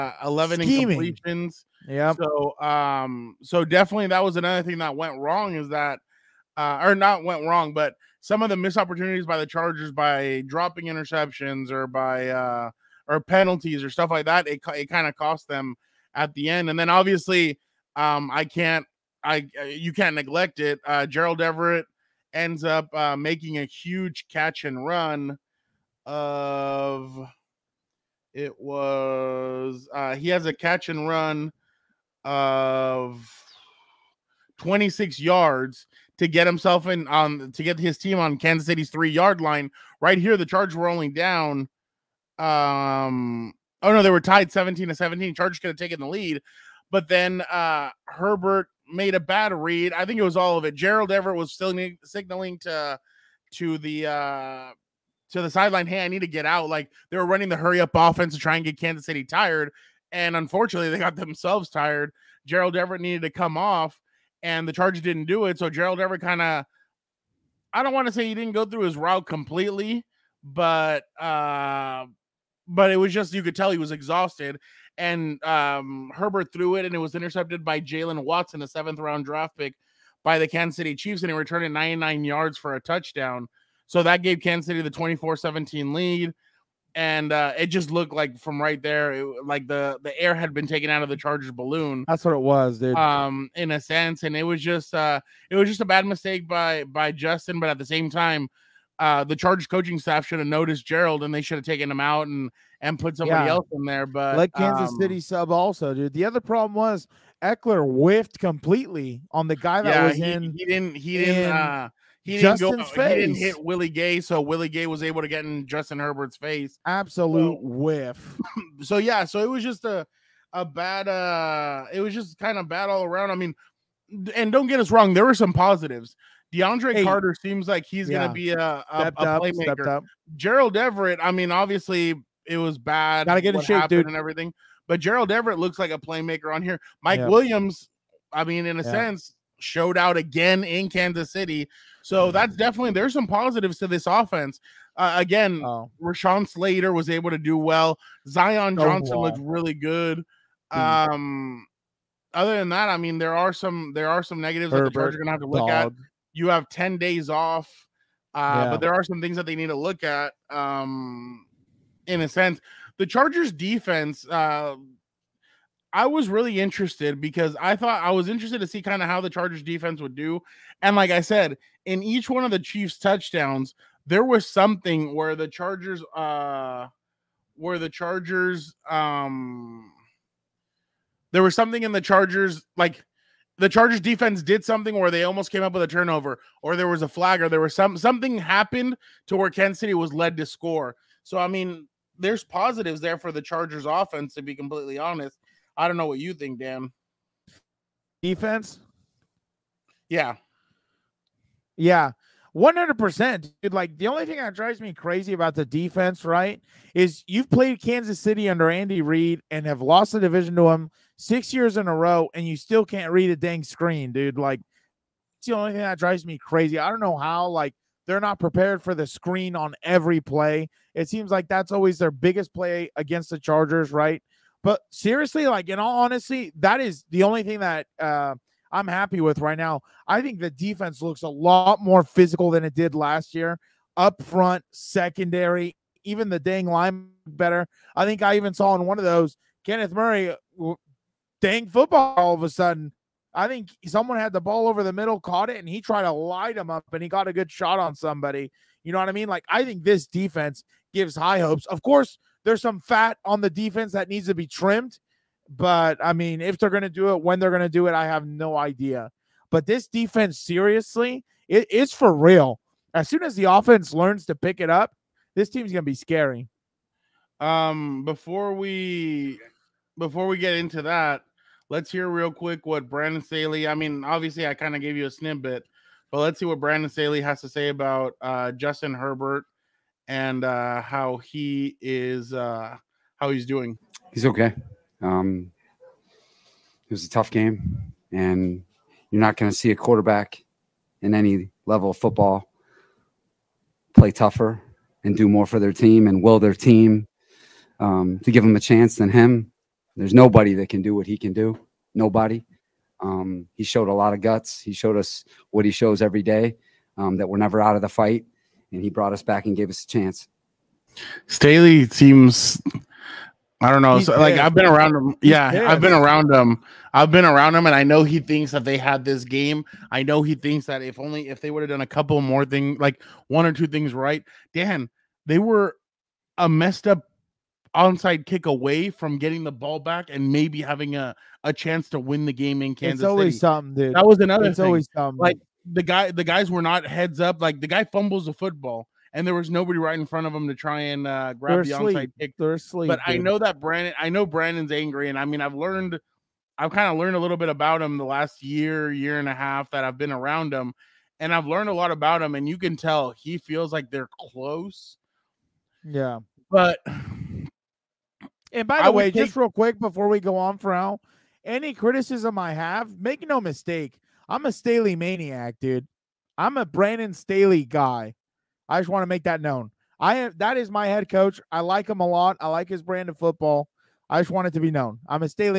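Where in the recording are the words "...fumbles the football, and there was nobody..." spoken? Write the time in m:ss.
5:37.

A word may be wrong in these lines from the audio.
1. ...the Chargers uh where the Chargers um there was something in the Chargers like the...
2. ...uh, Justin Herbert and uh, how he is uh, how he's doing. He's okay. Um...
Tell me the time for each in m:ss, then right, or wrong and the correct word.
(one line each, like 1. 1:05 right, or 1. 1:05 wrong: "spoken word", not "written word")
1. 2:55 right
2. 4:38 right.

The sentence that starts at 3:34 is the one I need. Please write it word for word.
Like, it's the only thing that drives me crazy.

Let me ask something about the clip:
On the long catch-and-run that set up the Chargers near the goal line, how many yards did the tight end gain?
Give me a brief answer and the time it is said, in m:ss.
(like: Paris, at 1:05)
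26, at 0:34.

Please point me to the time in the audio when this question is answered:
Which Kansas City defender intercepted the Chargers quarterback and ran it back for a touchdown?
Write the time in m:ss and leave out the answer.
1:17.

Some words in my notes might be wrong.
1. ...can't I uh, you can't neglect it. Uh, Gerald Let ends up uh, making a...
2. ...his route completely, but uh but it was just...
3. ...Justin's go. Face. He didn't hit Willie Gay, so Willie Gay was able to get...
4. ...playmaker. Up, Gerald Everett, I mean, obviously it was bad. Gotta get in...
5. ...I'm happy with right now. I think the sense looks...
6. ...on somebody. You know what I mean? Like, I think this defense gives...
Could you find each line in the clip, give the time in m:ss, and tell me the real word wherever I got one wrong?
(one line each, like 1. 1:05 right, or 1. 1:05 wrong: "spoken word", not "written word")
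1. 0:18 wrong: "Everett", not "Let"
2. 1:08 right
3. 1:52 right
4. 2:09 right
5. 3:48 wrong: "defense", not "sense"
6. 4:07 right.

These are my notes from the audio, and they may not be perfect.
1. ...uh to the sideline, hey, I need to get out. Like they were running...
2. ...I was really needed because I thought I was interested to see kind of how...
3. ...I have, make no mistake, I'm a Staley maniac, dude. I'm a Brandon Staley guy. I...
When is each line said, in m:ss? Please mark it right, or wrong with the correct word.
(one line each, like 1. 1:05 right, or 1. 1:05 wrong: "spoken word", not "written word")
1. 0:54 right
2. 2:45 wrong: "interested", not "needed"
3. 6:02 right.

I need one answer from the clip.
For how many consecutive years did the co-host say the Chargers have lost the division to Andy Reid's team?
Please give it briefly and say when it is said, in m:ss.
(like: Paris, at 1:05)
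6, at 3:31.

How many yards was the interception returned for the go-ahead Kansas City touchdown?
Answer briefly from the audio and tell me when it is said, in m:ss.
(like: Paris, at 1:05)
99, at 1:21.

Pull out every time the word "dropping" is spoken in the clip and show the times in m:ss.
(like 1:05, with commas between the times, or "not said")
0:10.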